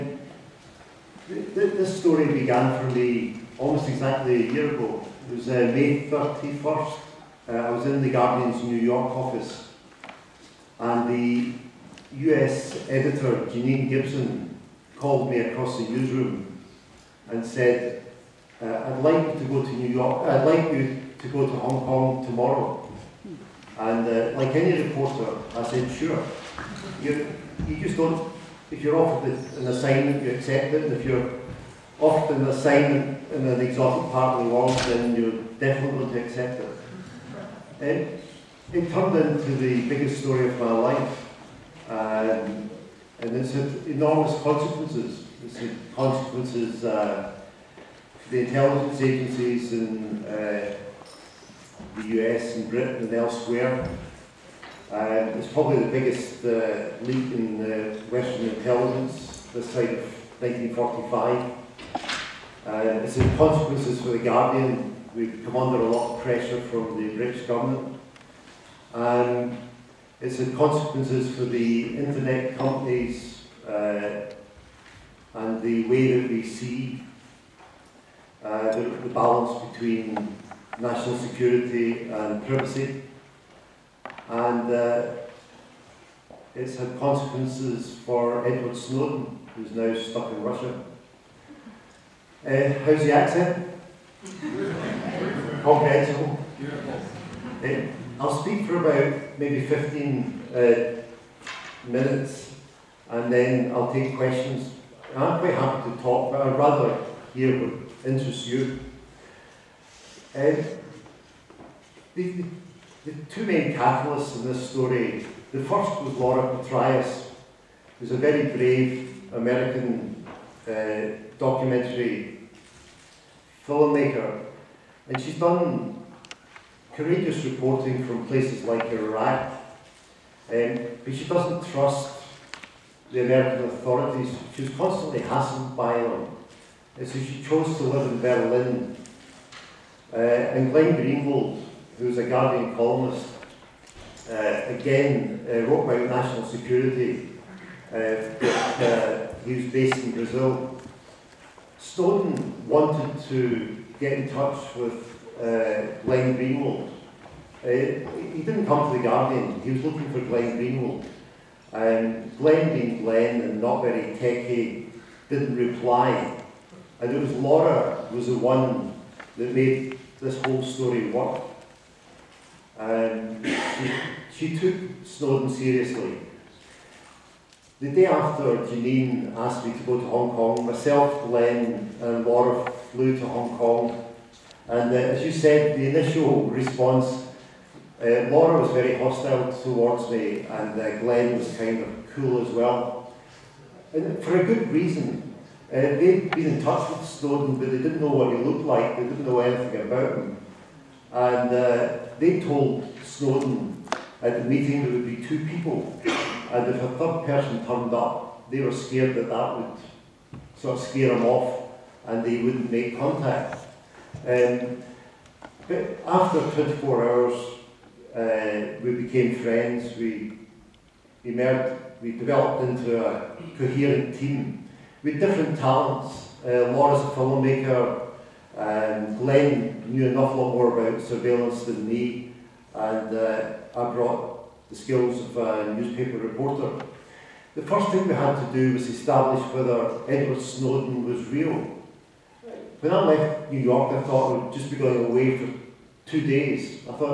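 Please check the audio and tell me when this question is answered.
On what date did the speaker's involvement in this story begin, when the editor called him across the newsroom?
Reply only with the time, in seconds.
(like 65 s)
5 s.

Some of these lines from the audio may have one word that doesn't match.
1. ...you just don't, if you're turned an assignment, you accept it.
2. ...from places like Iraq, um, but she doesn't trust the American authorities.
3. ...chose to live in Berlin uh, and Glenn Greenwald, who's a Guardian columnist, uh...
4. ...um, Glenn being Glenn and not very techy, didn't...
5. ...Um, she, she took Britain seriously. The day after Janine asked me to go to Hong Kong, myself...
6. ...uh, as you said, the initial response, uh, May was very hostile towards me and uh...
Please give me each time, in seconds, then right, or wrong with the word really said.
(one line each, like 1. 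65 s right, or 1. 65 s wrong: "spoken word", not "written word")
1. 27 s wrong: "offered", not "turned"
2. 128 s right
3. 137 s right
4. 162 s right
5. 172 s wrong: "Snowden", not "Britain"
6. 184 s wrong: "Laura", not "May".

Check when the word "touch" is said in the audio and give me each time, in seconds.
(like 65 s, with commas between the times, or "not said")
154 s, 196 s.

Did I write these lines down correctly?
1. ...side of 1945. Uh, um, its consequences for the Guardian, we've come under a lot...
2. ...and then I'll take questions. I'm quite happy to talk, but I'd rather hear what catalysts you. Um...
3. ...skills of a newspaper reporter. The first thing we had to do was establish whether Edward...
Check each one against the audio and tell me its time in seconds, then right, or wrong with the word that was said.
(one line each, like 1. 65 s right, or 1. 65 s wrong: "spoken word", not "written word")
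1. 59 s right
2. 103 s wrong: "interests", not "catalysts"
3. 234 s right.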